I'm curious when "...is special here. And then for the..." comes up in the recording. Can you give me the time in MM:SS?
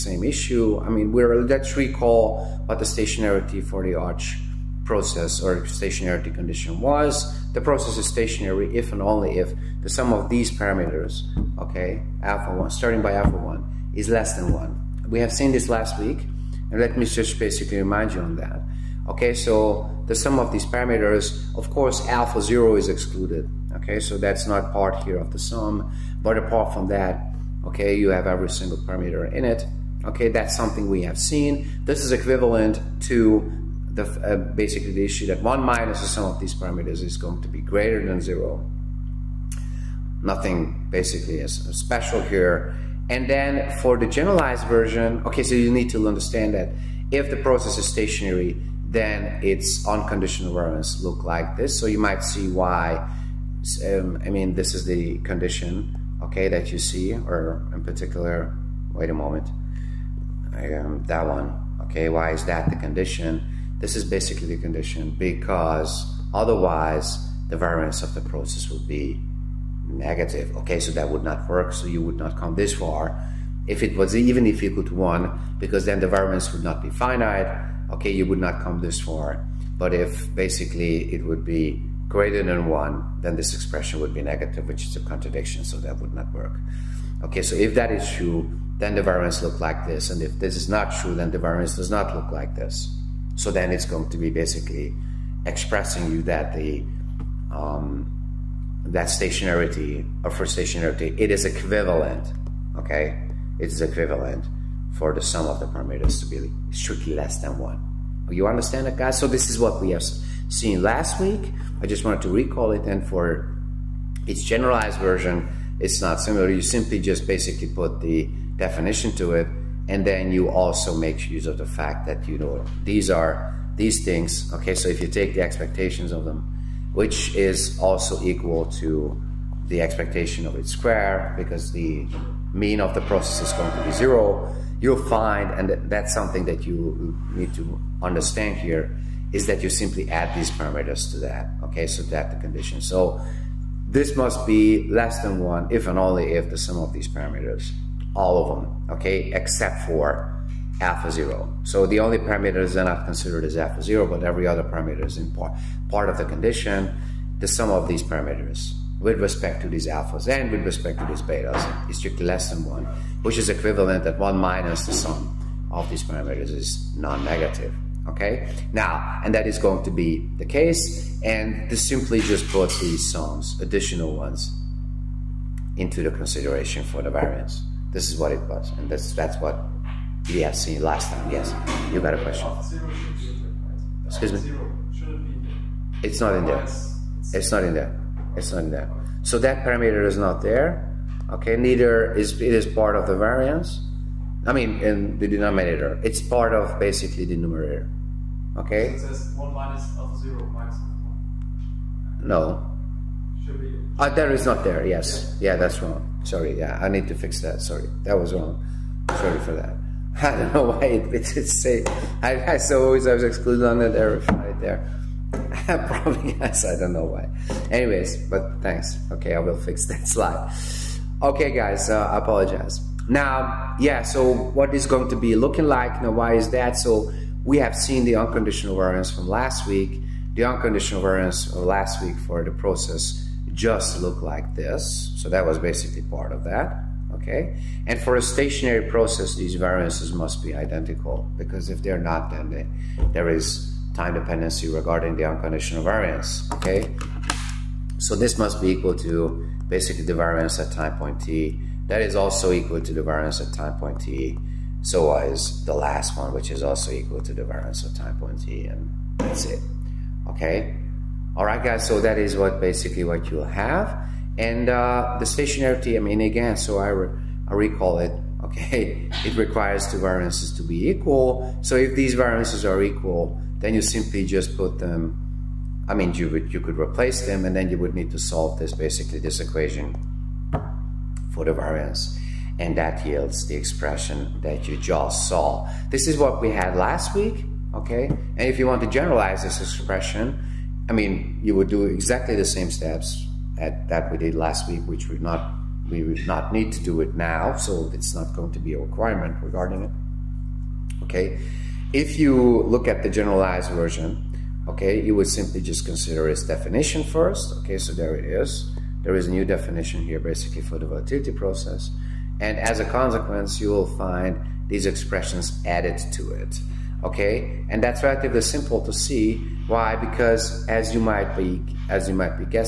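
00:41.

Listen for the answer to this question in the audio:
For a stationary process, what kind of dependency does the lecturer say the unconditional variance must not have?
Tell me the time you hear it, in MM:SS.
04:03.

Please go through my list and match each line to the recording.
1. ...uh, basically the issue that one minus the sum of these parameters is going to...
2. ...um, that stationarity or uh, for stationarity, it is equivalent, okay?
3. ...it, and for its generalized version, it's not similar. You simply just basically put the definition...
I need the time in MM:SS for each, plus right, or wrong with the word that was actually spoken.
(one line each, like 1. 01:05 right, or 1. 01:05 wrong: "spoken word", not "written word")
1. 00:34 right
2. 01:37 right
3. 01:52 right.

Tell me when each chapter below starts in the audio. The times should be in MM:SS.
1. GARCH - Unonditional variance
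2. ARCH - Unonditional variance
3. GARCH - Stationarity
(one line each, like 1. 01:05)
1. 05:02
2. 03:45
3. 01:52.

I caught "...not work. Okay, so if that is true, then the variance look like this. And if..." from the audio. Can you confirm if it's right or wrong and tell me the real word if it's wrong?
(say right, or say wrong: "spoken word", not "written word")
right.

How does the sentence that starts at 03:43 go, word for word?
Now, yeah, so what is going to be looking like?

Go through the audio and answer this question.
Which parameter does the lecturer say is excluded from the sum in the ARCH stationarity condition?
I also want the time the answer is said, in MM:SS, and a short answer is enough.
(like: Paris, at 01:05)
alpha 0, at 00:22.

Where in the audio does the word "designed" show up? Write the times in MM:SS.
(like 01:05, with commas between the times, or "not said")
not said.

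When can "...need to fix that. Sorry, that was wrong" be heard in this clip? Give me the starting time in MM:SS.
03:26.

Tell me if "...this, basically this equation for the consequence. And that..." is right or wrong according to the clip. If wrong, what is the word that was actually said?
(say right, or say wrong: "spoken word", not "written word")
wrong: "variance", not "consequence".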